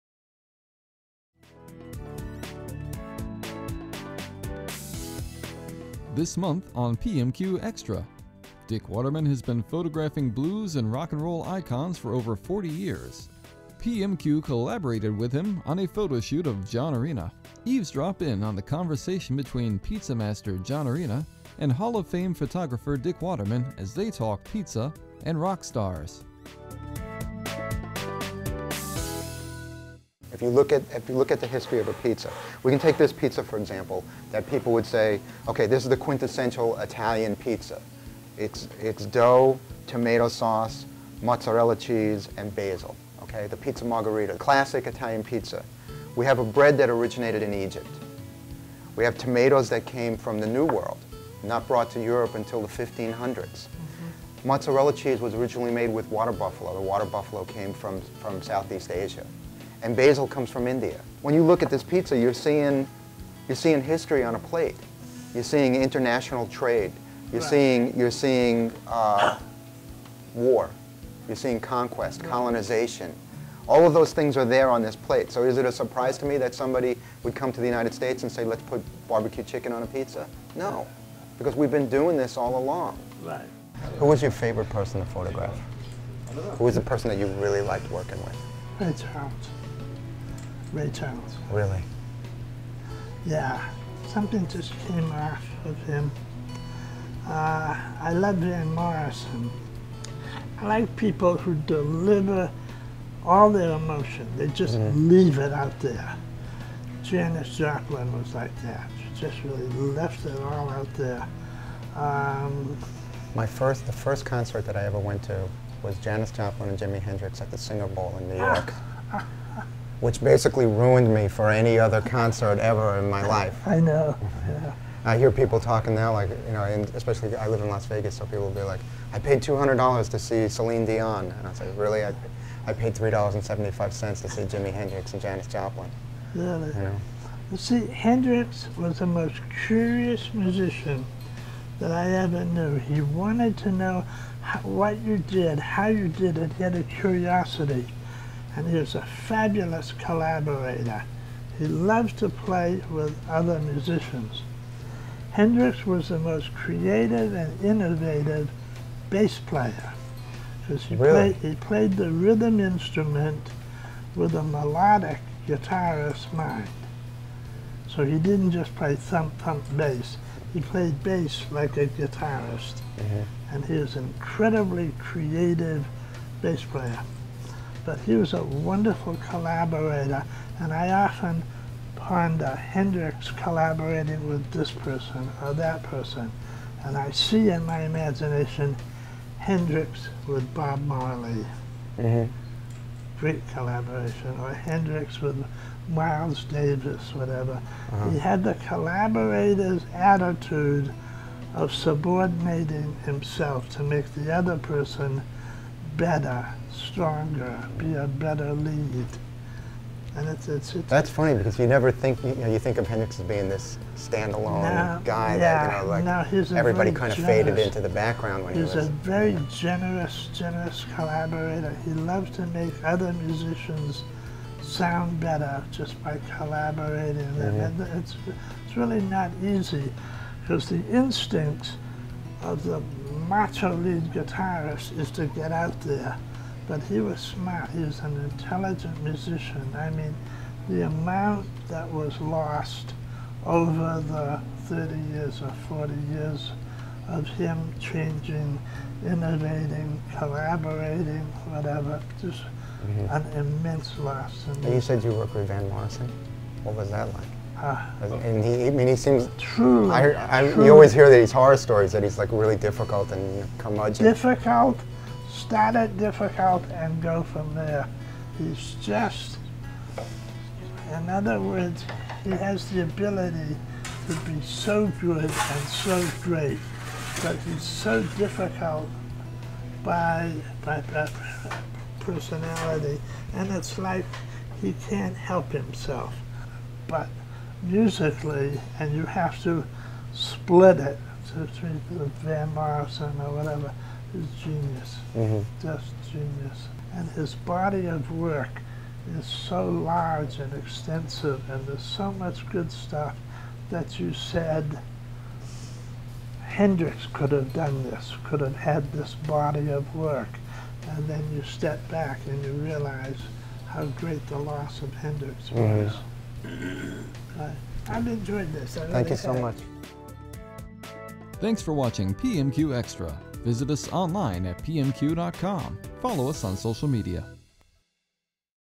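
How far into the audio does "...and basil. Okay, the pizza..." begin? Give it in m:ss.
0:42.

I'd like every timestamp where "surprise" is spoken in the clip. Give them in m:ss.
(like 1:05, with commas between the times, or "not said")
1:15.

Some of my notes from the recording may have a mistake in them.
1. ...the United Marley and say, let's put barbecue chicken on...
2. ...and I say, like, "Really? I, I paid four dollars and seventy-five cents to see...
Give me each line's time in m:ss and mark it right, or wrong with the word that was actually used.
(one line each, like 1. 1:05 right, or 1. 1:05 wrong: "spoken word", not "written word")
1. 1:17 wrong: "States", not "Marley"
2. 2:11 wrong: "three", not "four".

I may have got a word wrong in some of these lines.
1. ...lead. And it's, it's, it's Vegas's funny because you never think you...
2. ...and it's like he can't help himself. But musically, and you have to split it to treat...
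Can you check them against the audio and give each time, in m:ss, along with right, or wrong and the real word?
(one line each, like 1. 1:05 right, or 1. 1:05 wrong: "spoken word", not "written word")
1. 3:28 wrong: "That", not "Vegas"
2. 4:43 right.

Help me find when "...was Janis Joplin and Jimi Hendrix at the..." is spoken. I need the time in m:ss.
1:55.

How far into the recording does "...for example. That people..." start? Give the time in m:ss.
0:33.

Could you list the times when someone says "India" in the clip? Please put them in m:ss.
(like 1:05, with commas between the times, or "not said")
1:00.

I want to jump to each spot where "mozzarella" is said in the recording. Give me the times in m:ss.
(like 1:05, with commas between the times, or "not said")
0:41, 0:54.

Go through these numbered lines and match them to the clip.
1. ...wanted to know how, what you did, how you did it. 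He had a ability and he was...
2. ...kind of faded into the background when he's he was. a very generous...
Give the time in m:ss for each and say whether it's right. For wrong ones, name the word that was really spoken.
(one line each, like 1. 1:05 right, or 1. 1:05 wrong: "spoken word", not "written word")
1. 2:23 wrong: "curiosity", not "ability"
2. 3:36 right.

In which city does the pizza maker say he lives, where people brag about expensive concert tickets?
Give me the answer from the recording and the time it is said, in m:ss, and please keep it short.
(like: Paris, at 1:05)
Las Vegas, at 2:07.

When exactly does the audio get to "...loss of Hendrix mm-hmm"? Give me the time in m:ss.
5:14.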